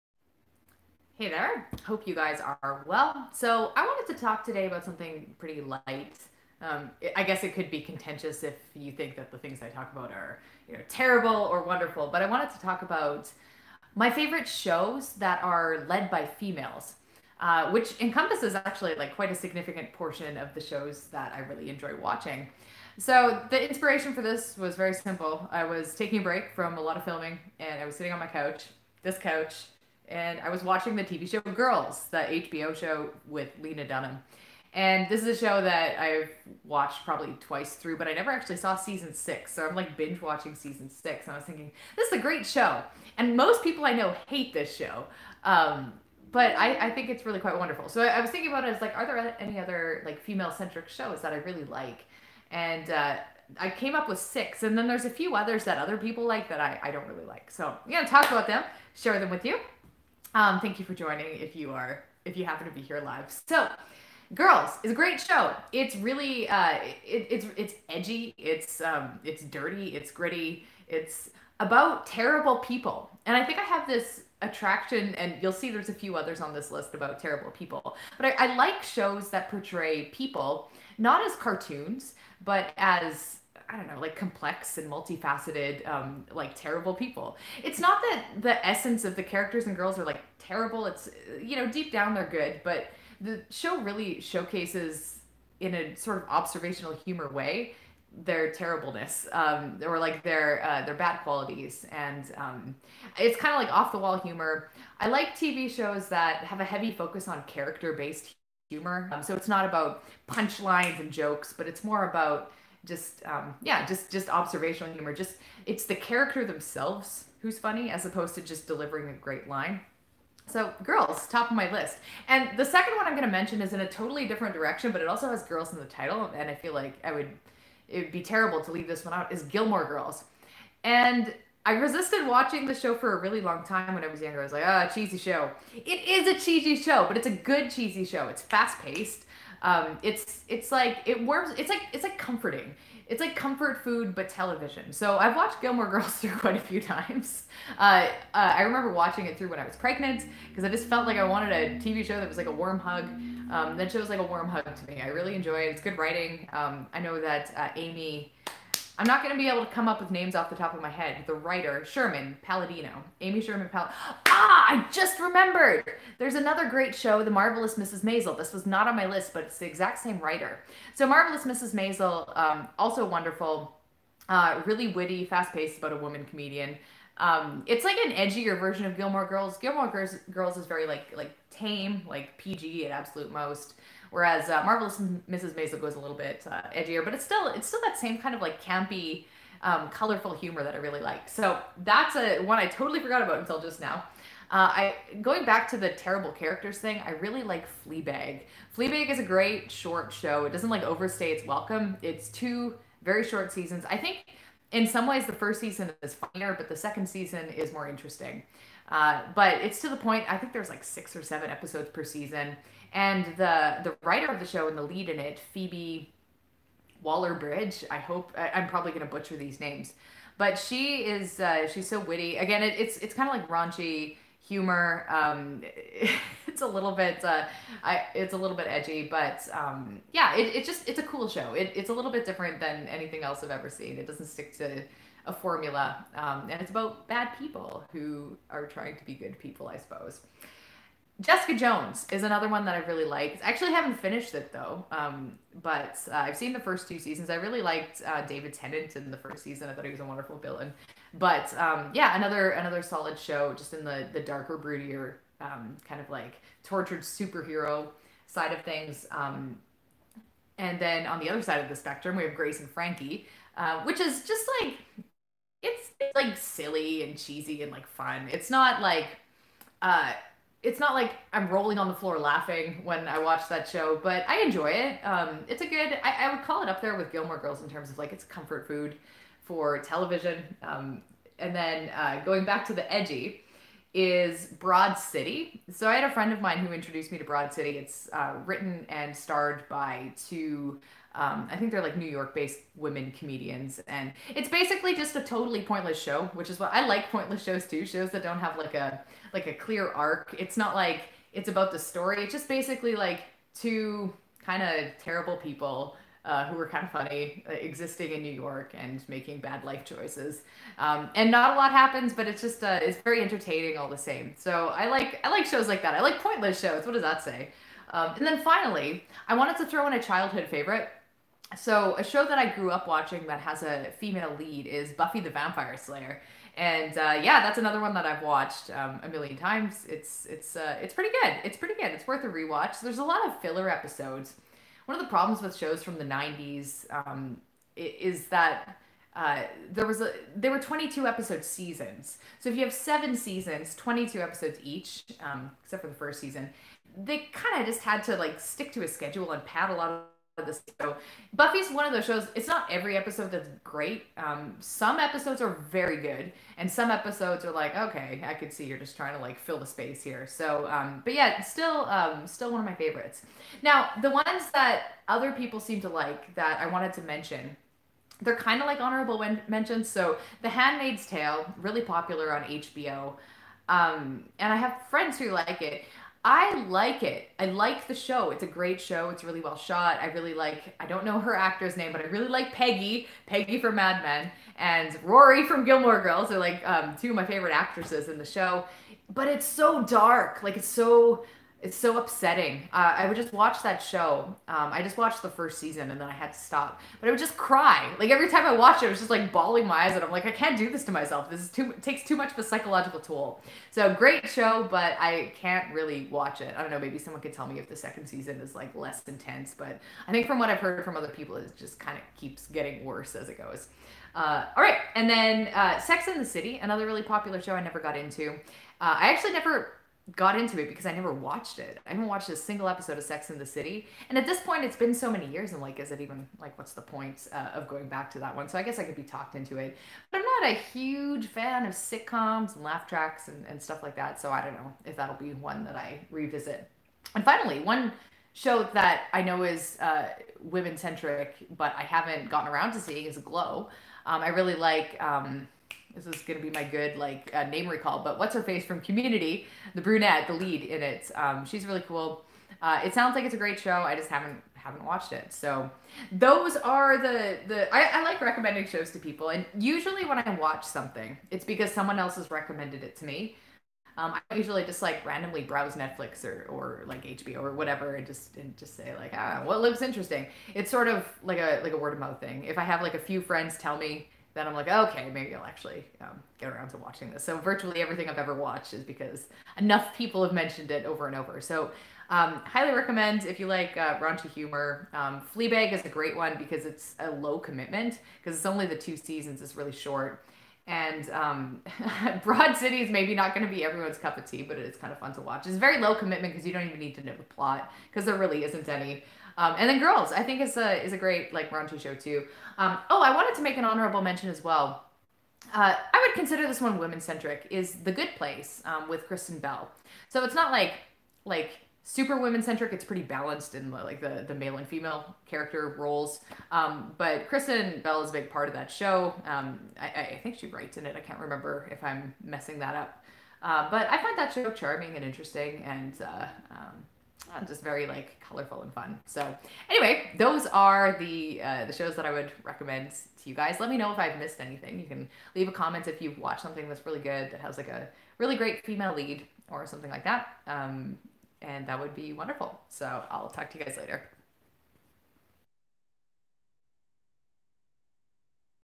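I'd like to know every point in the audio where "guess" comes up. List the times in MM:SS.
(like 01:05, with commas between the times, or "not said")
00:07, 07:08.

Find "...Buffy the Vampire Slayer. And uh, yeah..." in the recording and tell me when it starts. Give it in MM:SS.
05:24.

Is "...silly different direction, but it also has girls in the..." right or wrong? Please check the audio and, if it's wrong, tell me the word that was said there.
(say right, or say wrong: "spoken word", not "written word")
wrong: "totally", not "silly".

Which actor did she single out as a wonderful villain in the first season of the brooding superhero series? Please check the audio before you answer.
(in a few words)
David Tennant.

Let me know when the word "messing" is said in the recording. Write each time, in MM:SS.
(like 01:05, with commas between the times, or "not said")
08:42.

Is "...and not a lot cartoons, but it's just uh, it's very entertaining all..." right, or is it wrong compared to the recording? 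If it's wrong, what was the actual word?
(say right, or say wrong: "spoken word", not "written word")
wrong: "happens", not "cartoons".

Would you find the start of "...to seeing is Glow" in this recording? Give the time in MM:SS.
07:22.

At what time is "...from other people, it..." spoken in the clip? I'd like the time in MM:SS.
06:50.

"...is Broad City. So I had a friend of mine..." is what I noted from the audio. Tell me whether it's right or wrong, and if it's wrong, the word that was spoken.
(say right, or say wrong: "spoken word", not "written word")
right.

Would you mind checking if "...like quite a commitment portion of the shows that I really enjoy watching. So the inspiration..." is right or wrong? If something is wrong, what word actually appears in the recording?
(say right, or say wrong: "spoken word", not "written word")
wrong: "significant", not "commitment".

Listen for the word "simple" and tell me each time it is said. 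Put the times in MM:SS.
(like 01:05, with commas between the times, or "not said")
00:24.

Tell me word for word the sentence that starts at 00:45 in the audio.
Um, but I, I, think it's really quite wonderful.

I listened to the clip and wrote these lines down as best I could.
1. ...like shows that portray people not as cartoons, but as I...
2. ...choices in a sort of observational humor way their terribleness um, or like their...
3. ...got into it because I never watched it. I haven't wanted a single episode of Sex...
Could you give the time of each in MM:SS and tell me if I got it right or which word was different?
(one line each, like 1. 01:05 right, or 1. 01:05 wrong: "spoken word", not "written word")
1. 01:18 right
2. 01:34 wrong: "showcases", not "choices"
3. 07:00 wrong: "watched", not "wanted".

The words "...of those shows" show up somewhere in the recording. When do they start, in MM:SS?
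05:51.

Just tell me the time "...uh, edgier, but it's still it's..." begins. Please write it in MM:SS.
03:06.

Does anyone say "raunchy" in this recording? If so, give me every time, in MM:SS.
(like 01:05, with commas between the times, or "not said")
03:43, 08:03.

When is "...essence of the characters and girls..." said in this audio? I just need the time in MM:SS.
01:28.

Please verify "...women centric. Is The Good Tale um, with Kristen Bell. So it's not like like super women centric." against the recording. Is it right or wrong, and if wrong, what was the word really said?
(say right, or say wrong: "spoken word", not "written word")
wrong: "Place", not "Tale".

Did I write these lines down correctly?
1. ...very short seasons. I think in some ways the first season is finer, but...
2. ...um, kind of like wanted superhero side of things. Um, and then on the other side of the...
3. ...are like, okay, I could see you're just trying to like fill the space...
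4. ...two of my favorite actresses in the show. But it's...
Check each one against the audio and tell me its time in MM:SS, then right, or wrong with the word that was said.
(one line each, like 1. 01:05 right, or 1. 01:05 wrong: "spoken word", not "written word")
1. 03:23 right
2. 04:15 wrong: "tortured", not "wanted"
3. 05:57 right
4. 06:27 right.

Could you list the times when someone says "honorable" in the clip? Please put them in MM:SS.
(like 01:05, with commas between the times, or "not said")
06:08, 08:23.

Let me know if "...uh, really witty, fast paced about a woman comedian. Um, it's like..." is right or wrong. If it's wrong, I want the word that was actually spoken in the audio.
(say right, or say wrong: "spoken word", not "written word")
right.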